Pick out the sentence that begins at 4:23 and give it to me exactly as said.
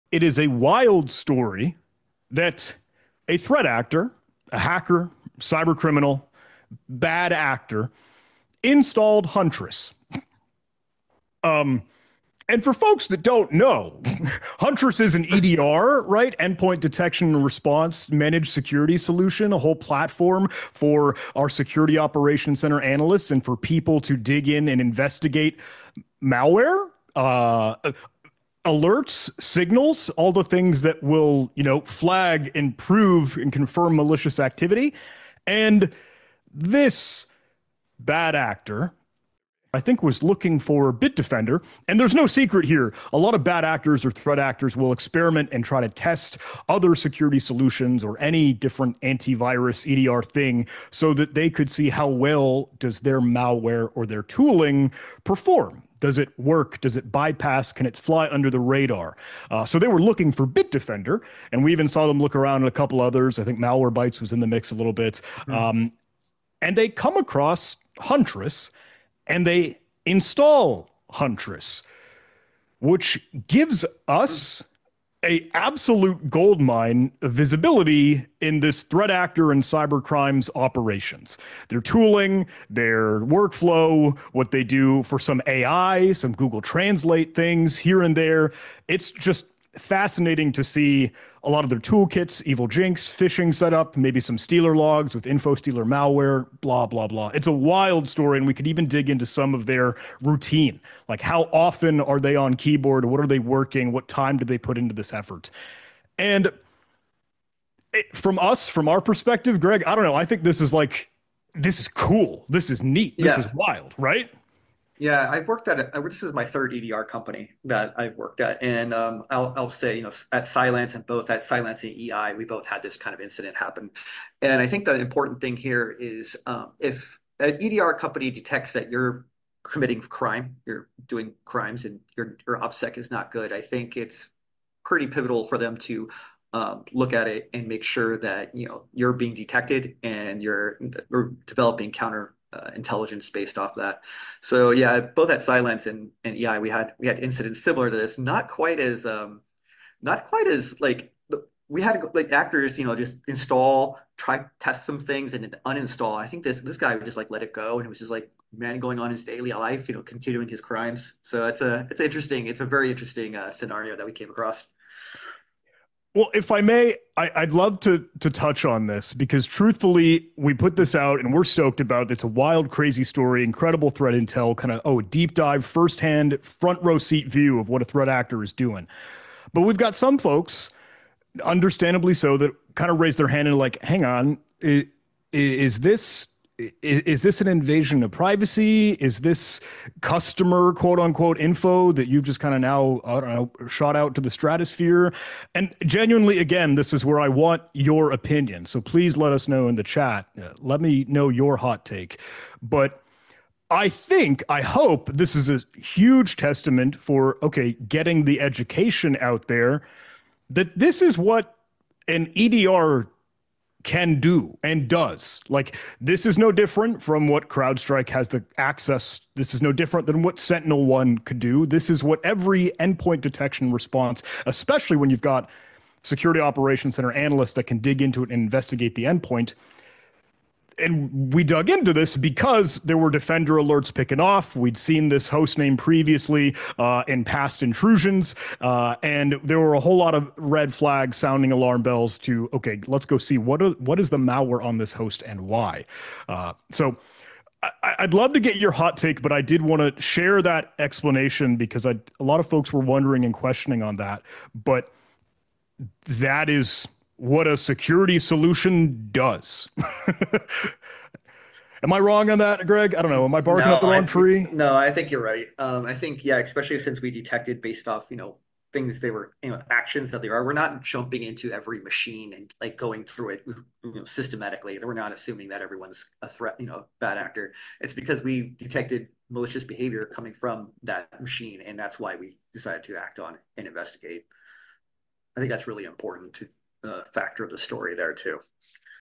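Am I barking no, up the wrong tree?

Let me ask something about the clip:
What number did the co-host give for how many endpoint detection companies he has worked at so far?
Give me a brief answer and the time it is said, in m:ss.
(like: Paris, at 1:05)
3, at 1:56.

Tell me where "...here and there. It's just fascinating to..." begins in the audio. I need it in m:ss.
1:27.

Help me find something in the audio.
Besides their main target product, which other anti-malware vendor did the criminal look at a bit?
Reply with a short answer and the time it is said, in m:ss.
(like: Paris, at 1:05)
Malwarebytes, at 1:03.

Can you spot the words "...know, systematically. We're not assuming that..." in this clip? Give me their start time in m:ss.
4:33.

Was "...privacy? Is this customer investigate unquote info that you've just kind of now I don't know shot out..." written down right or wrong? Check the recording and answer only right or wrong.
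wrong.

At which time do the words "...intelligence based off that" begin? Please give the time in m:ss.
2:22.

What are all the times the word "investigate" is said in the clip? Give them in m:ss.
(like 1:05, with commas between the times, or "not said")
0:24, 3:48, 4:43.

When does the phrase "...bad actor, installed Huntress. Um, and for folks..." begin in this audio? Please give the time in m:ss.
0:06.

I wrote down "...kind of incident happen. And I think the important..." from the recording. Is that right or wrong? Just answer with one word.
right.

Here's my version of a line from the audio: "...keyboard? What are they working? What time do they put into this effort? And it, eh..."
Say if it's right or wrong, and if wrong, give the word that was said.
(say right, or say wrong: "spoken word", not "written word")
right.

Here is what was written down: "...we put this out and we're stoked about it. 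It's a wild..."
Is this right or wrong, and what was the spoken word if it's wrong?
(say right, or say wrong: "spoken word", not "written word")
right.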